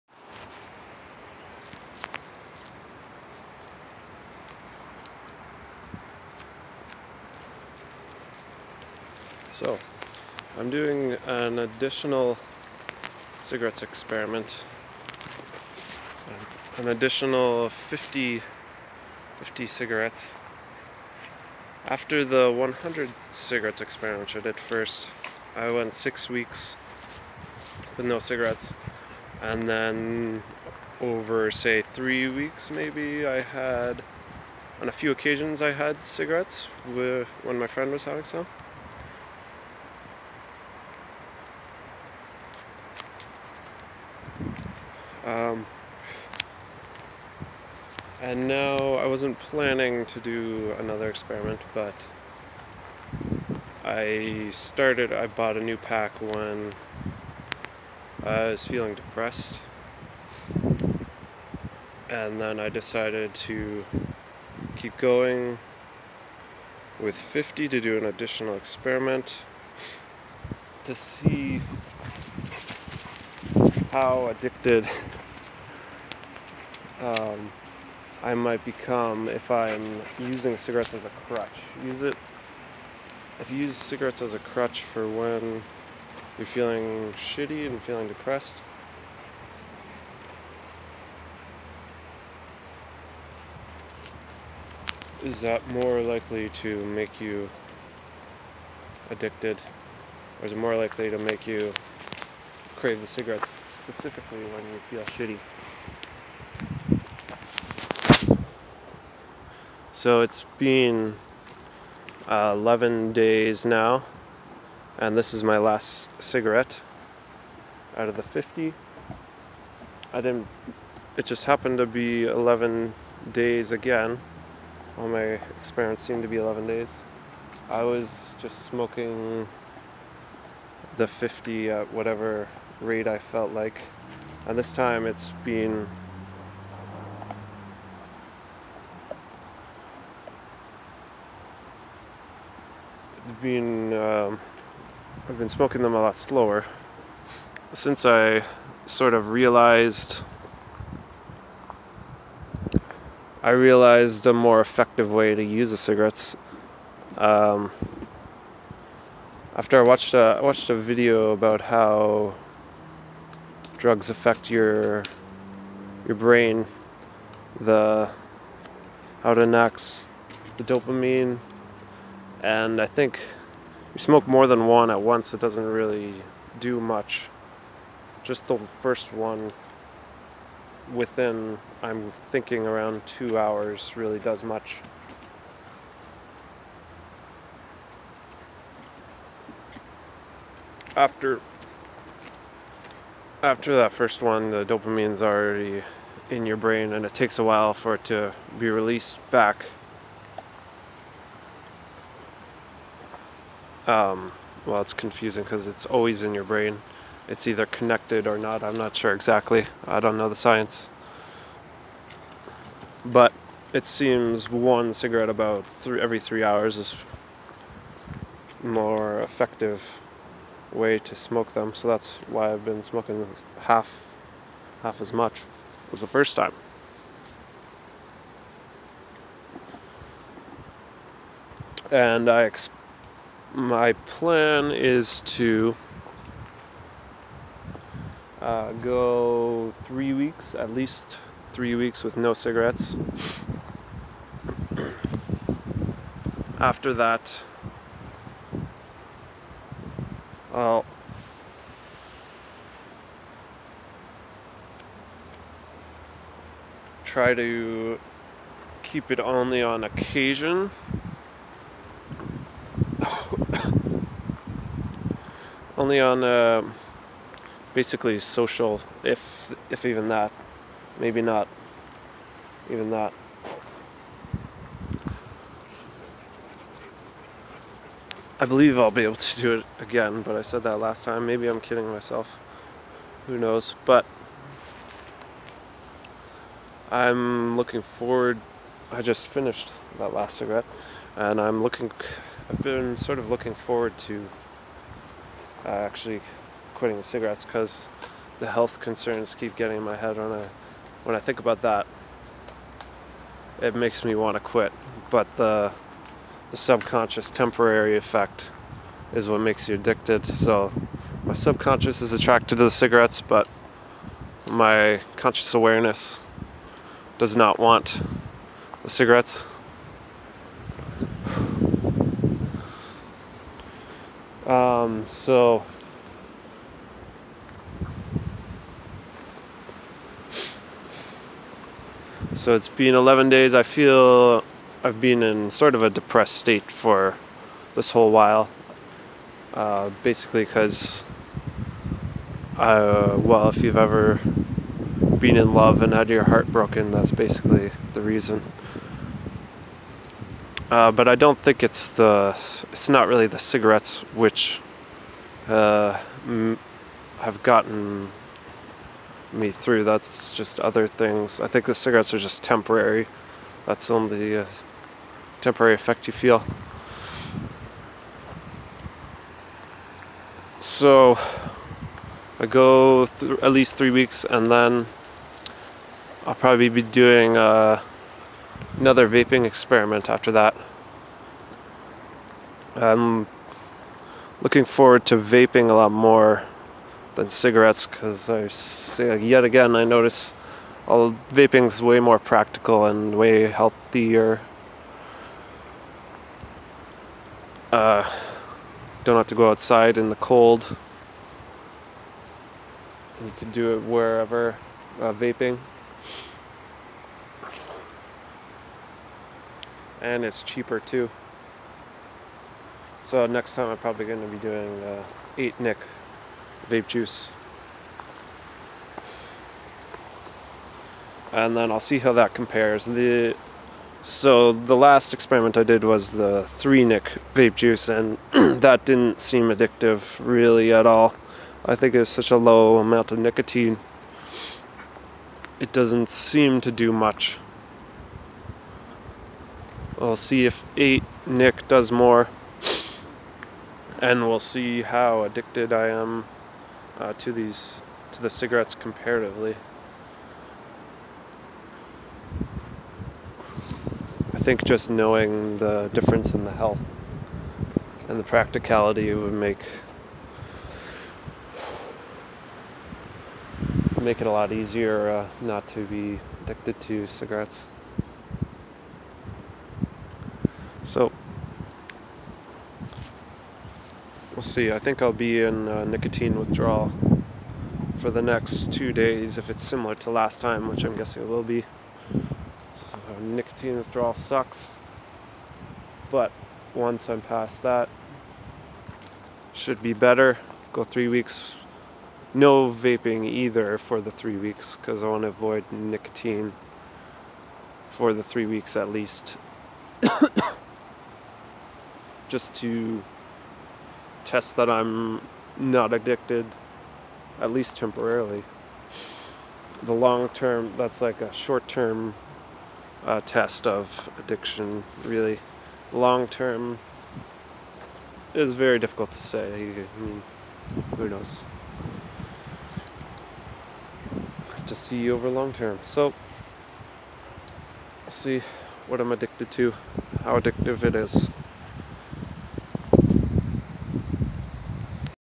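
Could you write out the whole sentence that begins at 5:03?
It makes me want to quit, but the the subconscious temporary effect is what makes you addicted.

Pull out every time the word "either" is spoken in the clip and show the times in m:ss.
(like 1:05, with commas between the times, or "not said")
3:27, 8:13.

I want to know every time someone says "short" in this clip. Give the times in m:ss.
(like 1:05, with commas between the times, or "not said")
8:31.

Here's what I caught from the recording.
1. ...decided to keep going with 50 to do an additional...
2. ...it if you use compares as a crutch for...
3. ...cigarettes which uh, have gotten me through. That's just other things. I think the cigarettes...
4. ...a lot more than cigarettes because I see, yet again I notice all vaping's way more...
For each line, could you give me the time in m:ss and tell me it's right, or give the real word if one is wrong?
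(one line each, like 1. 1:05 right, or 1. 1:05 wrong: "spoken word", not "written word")
1. 1:02 right
2. 1:22 wrong: "cigarettes", not "compares"
3. 5:53 right
4. 6:25 right.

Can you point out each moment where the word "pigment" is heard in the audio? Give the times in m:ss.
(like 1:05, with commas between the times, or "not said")
not said.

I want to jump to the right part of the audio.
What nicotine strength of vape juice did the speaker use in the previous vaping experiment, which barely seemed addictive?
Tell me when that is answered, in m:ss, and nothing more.
7:06.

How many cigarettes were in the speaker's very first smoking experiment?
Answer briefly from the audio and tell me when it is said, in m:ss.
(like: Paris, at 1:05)
100, at 0:22.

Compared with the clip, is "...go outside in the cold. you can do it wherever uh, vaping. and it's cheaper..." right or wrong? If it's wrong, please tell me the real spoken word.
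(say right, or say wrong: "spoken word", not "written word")
right.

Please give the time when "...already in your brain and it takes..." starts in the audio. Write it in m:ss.
3:15.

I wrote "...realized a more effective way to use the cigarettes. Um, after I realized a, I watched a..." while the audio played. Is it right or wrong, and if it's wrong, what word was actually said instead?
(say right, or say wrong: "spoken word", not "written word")
wrong: "watched", not "realized".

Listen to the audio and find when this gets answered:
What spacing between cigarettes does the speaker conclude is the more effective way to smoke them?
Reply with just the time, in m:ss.
3:35.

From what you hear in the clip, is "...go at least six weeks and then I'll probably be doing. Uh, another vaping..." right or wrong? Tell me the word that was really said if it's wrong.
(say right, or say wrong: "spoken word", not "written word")
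wrong: "three", not "six".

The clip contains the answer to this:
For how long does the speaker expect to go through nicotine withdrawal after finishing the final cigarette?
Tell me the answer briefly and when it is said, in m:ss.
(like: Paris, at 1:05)
two days, at 7:58.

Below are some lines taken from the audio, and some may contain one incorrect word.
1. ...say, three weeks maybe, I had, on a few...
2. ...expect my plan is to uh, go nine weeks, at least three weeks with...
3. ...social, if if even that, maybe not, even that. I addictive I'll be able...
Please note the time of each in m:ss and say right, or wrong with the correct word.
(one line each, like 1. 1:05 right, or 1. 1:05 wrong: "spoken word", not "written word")
1. 0:31 right
2. 3:52 wrong: "three", not "nine"
3. 4:28 wrong: "believe", not "addictive".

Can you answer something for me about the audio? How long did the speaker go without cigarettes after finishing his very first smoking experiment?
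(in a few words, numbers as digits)
six weeks.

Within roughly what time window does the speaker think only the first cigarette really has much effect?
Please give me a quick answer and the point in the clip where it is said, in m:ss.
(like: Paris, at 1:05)
two hours, at 3:03.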